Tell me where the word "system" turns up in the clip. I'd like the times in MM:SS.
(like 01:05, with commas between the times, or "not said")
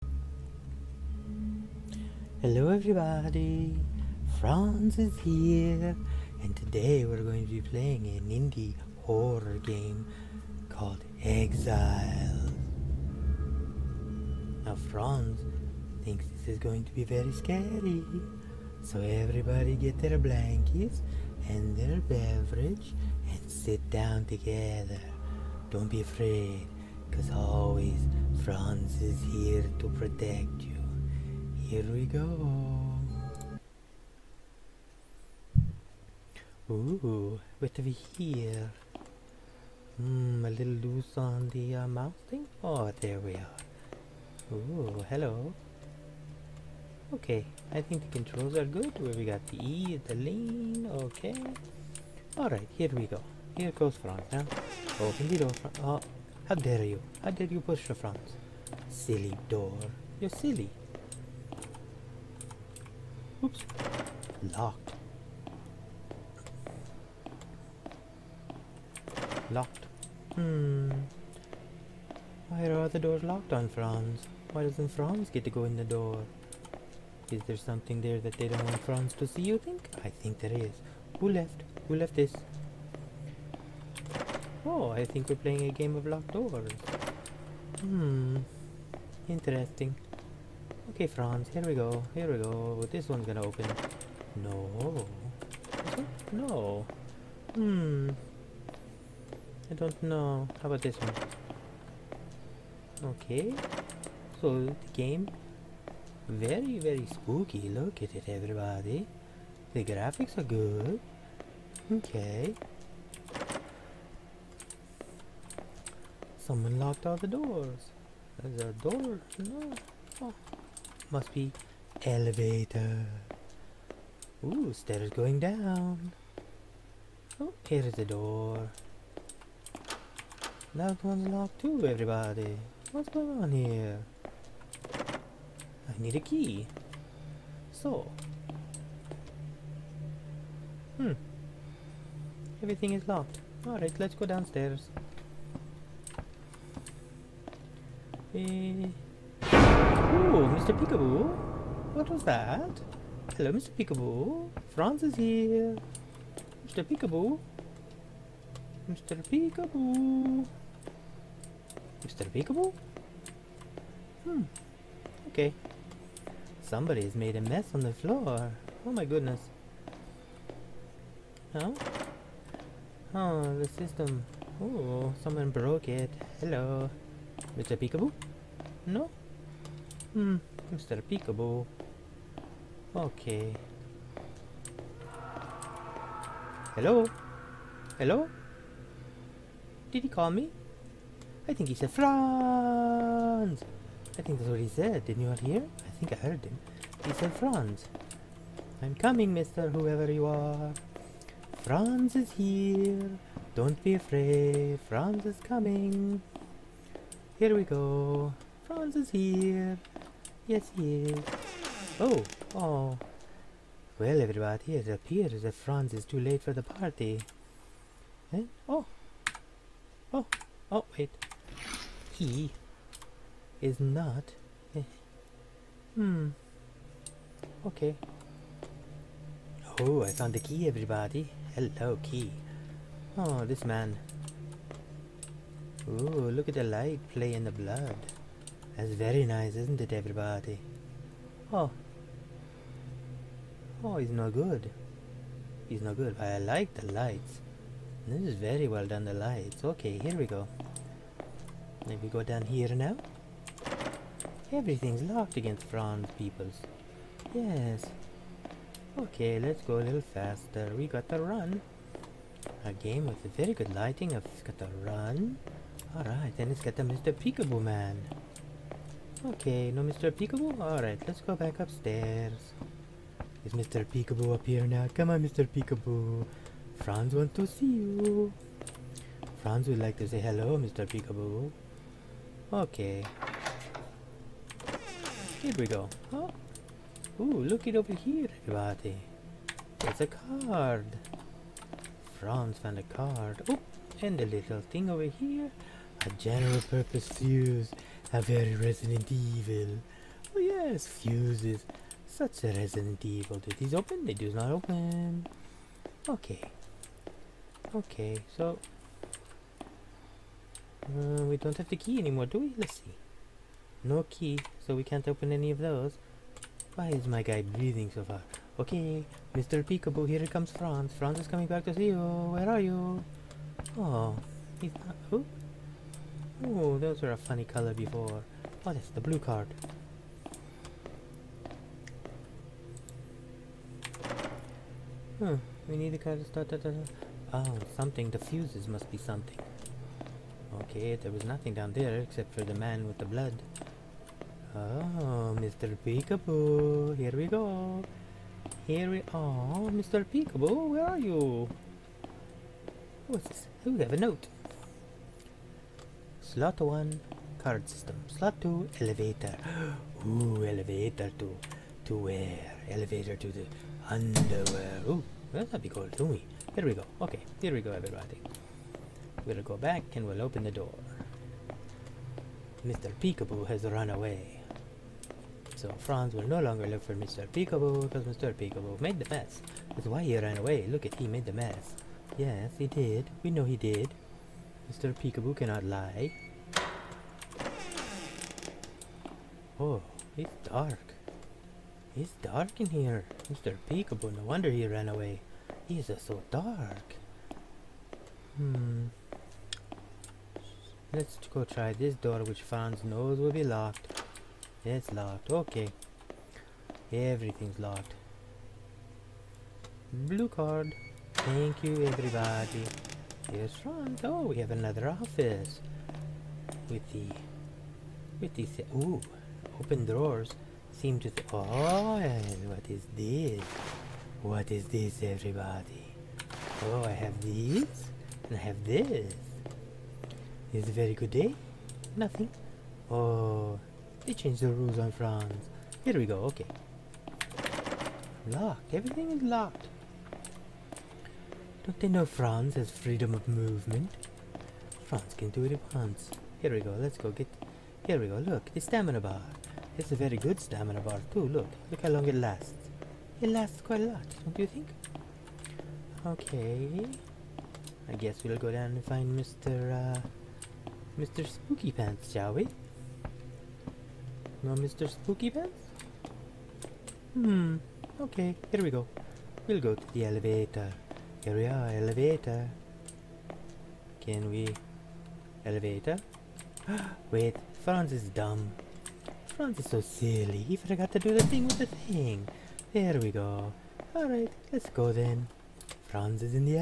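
02:53, 05:57.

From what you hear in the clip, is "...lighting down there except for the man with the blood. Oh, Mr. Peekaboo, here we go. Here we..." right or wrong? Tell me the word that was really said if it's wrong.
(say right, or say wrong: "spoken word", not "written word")
wrong: "nothing", not "lighting".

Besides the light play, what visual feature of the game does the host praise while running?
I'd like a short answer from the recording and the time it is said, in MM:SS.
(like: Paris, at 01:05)
lighting, at 04:23.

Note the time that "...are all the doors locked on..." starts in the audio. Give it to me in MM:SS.
01:12.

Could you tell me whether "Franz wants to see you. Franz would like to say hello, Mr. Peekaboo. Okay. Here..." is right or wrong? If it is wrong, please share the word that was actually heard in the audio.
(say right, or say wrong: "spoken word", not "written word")
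right.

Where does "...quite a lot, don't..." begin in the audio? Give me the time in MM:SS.
07:33.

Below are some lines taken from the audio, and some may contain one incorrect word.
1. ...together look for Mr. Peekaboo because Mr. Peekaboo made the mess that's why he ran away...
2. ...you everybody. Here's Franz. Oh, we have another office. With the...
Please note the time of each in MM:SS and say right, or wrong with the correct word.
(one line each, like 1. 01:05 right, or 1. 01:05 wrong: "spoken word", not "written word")
1. 06:16 wrong: "longer", not "together"
2. 06:51 right.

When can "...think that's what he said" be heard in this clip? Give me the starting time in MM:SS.
03:14.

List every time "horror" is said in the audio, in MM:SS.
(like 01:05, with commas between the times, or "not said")
00:09.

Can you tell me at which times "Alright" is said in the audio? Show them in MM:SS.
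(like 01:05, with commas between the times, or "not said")
00:52, 02:23, 04:25, 04:30, 08:03.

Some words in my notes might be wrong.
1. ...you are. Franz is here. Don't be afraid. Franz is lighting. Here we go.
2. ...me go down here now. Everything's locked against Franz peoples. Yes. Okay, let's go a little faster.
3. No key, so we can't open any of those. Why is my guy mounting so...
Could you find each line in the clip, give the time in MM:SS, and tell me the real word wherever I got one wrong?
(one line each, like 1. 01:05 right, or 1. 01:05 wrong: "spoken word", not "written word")
1. 03:20 wrong: "coming", not "lighting"
2. 04:12 right
3. 05:13 wrong: "breathing", not "mounting".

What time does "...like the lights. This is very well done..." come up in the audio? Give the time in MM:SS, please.
04:06.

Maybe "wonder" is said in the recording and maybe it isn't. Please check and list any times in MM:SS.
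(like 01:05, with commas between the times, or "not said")
06:34.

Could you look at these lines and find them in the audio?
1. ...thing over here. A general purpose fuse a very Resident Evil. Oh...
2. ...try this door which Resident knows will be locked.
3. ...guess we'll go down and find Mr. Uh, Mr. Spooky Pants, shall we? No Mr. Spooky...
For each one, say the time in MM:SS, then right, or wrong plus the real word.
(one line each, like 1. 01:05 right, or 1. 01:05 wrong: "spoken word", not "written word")
1. 04:54 right
2. 06:41 wrong: "Franz", not "Resident"
3. 07:37 right.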